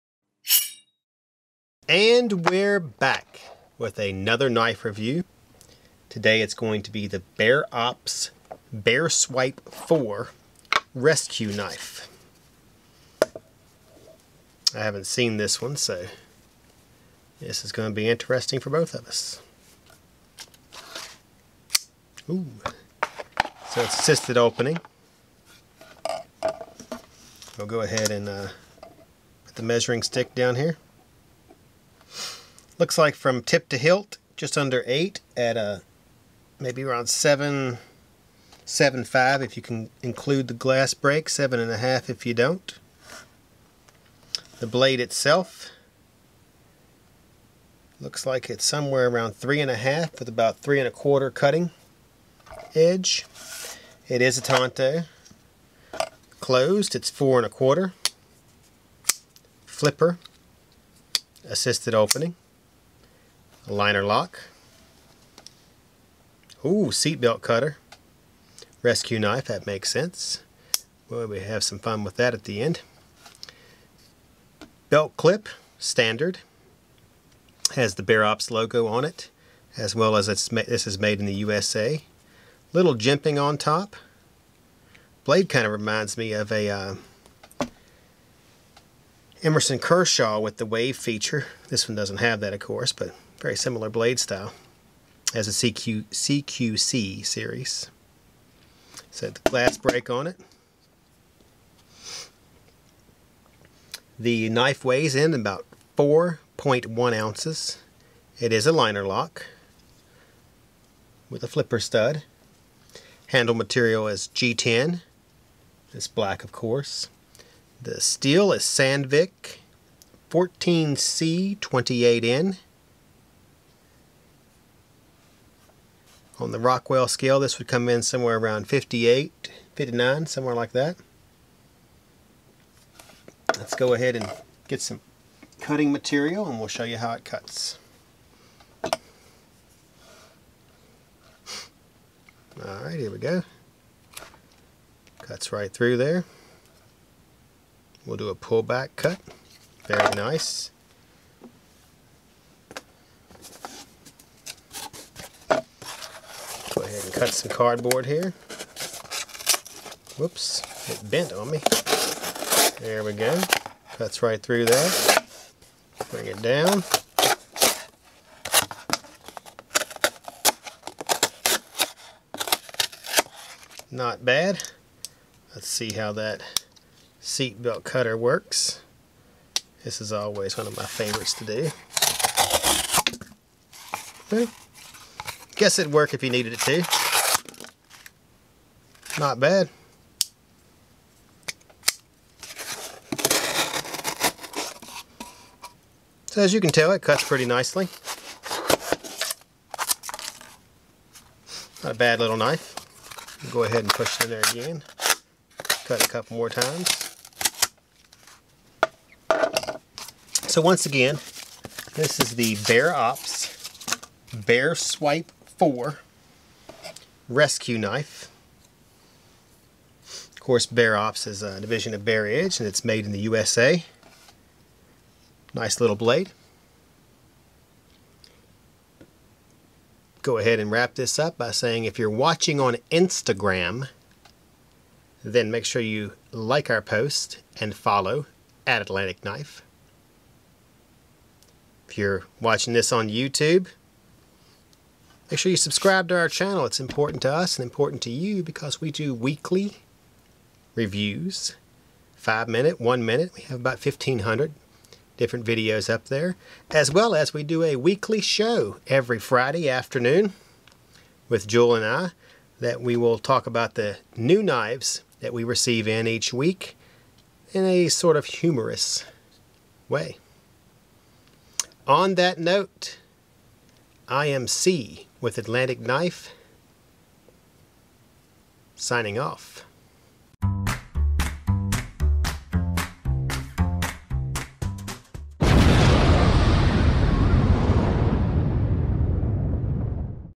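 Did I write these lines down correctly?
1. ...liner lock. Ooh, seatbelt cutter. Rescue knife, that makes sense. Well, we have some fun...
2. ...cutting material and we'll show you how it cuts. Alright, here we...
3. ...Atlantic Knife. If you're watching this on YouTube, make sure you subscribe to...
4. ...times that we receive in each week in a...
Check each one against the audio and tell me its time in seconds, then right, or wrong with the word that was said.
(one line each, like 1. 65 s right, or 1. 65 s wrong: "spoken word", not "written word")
1. 63 s right
2. 135 s right
3. 238 s right
4. 264 s wrong: "knives", not "times".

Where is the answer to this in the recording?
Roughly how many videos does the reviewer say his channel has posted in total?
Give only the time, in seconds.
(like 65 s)
253 s.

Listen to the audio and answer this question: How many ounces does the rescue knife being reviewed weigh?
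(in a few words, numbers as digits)
4.1 ounces.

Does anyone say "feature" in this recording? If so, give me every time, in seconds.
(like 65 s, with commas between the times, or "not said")
90 s.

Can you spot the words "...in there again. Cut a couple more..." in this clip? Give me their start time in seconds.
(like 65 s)
204 s.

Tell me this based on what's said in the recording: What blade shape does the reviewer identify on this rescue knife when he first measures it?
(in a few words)
Tonto.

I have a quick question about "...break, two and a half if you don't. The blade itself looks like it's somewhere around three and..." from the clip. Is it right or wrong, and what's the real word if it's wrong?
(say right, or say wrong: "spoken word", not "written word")
wrong: "seven", not "two".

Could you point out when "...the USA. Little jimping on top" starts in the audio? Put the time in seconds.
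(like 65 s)
81 s.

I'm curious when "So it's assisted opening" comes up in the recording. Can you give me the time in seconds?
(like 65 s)
23 s.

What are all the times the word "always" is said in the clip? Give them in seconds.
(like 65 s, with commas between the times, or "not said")
180 s.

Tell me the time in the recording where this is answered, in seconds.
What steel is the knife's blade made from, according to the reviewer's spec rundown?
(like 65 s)
118 s.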